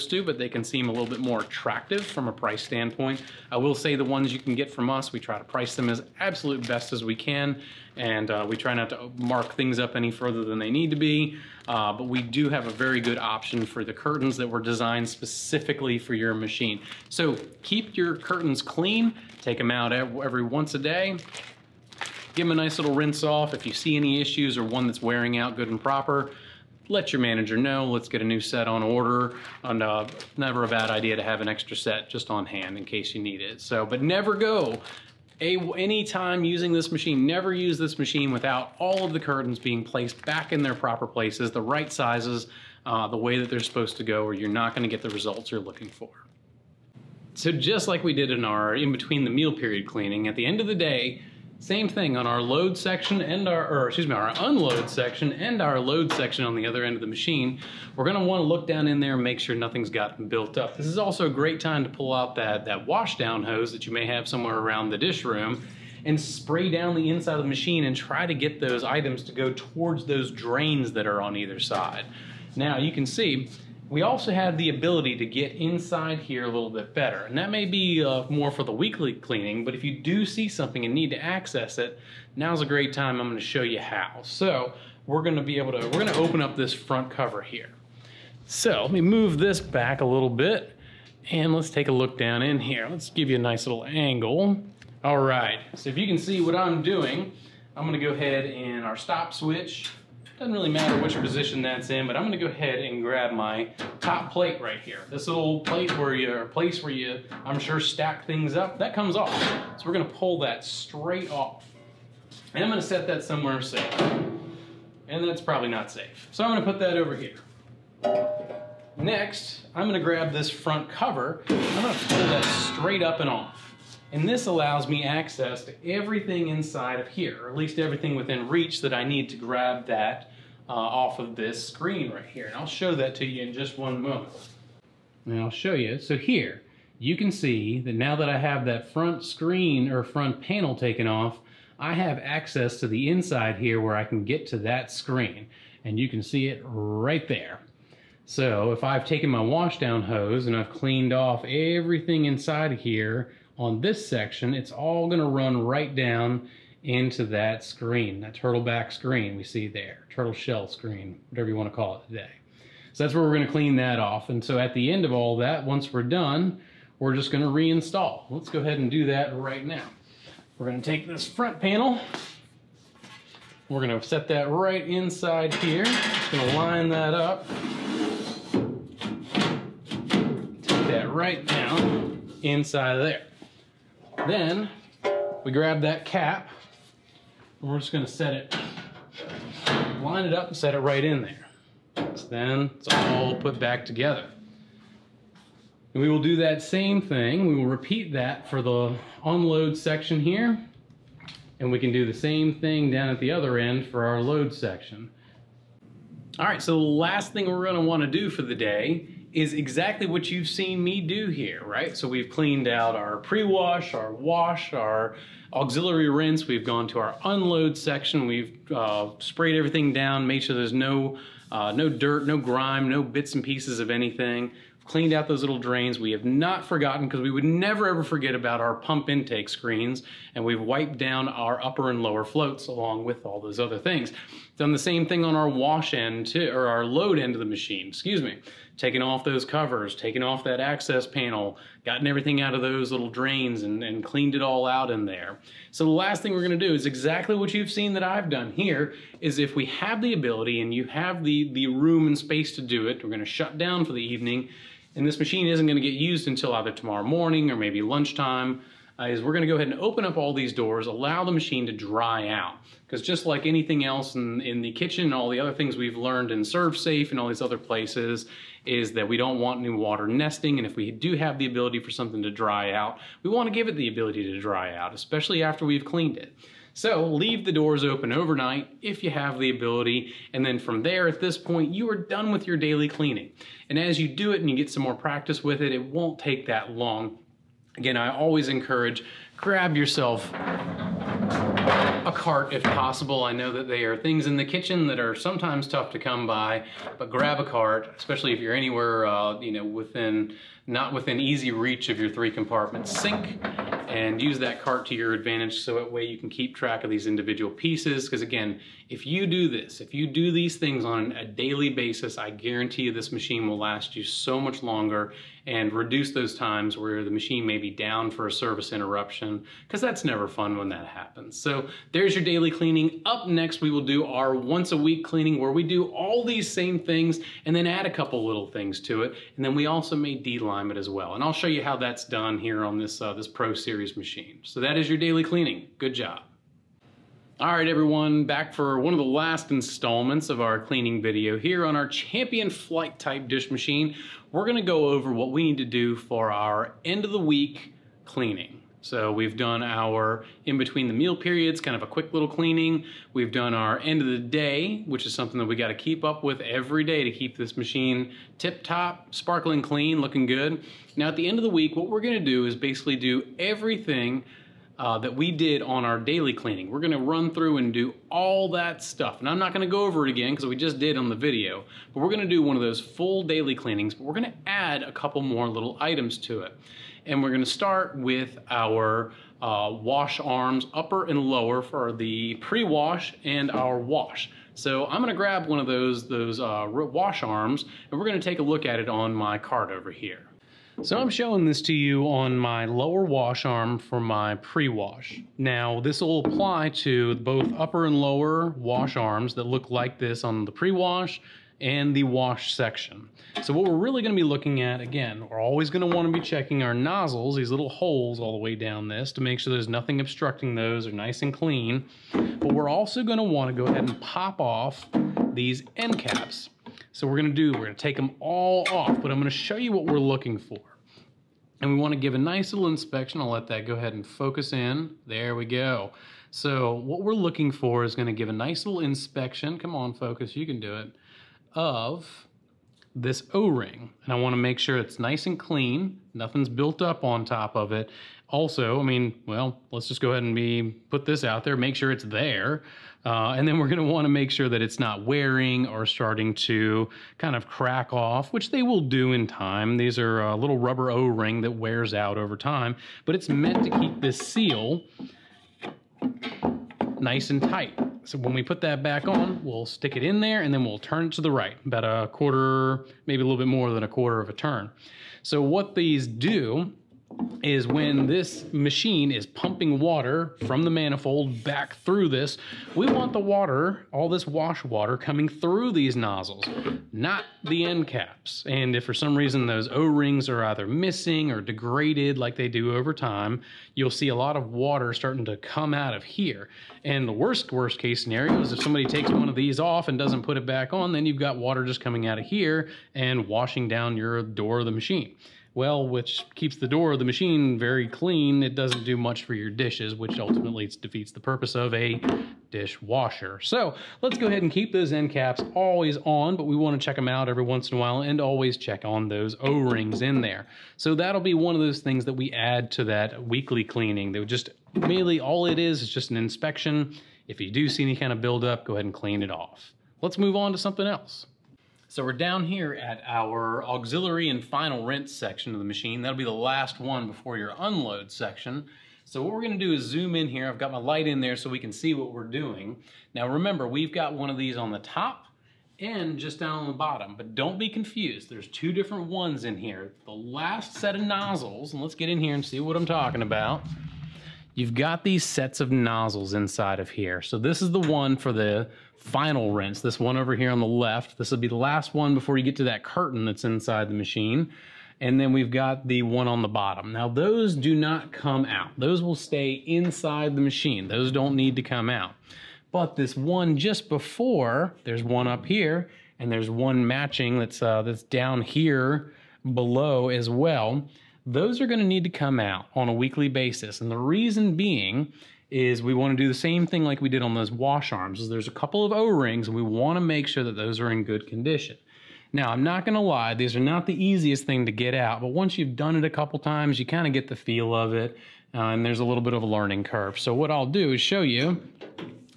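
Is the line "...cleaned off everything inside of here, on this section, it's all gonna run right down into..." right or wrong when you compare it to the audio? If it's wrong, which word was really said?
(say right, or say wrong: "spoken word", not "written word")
right.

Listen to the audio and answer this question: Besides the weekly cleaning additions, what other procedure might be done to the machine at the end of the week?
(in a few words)
de-lime.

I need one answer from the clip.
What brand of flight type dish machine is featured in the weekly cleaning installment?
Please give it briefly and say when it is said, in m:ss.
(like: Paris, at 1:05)
Champion, at 5:41.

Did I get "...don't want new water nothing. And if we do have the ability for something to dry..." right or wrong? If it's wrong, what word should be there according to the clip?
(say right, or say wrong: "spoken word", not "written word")
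wrong: "nesting", not "nothing".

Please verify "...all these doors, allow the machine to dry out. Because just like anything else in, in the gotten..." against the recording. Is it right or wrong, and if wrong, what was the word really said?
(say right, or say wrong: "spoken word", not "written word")
wrong: "kitchen", not "gotten".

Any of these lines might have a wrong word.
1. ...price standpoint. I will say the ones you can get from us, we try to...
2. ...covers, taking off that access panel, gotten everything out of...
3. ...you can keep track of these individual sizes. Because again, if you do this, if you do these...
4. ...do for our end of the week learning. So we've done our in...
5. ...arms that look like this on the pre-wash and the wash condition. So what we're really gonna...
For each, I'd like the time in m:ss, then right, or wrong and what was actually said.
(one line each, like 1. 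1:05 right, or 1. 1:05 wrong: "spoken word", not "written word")
1. 0:02 right
2. 3:59 right
3. 5:06 wrong: "pieces", not "sizes"
4. 5:45 wrong: "cleaning", not "learning"
5. 6:38 wrong: "section", not "condition".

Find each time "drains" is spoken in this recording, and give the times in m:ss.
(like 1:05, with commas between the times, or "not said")
1:10, 3:45, 4:03.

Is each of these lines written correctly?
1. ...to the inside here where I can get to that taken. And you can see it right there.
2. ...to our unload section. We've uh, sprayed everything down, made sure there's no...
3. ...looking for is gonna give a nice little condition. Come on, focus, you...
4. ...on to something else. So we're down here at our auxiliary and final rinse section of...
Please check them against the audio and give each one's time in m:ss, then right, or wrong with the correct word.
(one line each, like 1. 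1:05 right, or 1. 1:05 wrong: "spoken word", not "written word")
1. 2:22 wrong: "screen", not "taken"
2. 3:36 right
3. 7:07 wrong: "inspection", not "condition"
4. 8:40 right.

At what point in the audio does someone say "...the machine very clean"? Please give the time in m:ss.
8:16.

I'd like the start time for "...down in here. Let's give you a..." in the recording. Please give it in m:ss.
1:32.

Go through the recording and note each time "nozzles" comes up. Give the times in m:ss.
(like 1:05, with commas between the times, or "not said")
6:46, 7:55, 9:01, 9:05.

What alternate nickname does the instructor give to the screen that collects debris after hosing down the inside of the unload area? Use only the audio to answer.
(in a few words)
turtle shell screen.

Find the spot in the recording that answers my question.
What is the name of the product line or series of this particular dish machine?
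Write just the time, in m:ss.
5:33.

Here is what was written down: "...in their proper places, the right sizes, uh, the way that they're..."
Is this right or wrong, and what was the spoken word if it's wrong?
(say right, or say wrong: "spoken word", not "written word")
right.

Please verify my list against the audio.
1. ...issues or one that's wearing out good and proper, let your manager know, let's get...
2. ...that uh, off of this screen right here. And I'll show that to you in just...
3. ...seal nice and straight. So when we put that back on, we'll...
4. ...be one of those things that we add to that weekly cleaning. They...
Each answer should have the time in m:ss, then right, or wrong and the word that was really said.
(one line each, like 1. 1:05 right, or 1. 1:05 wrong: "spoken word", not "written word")
1. 0:24 right
2. 2:09 right
3. 7:34 wrong: "tight", not "straight"
4. 8:31 right.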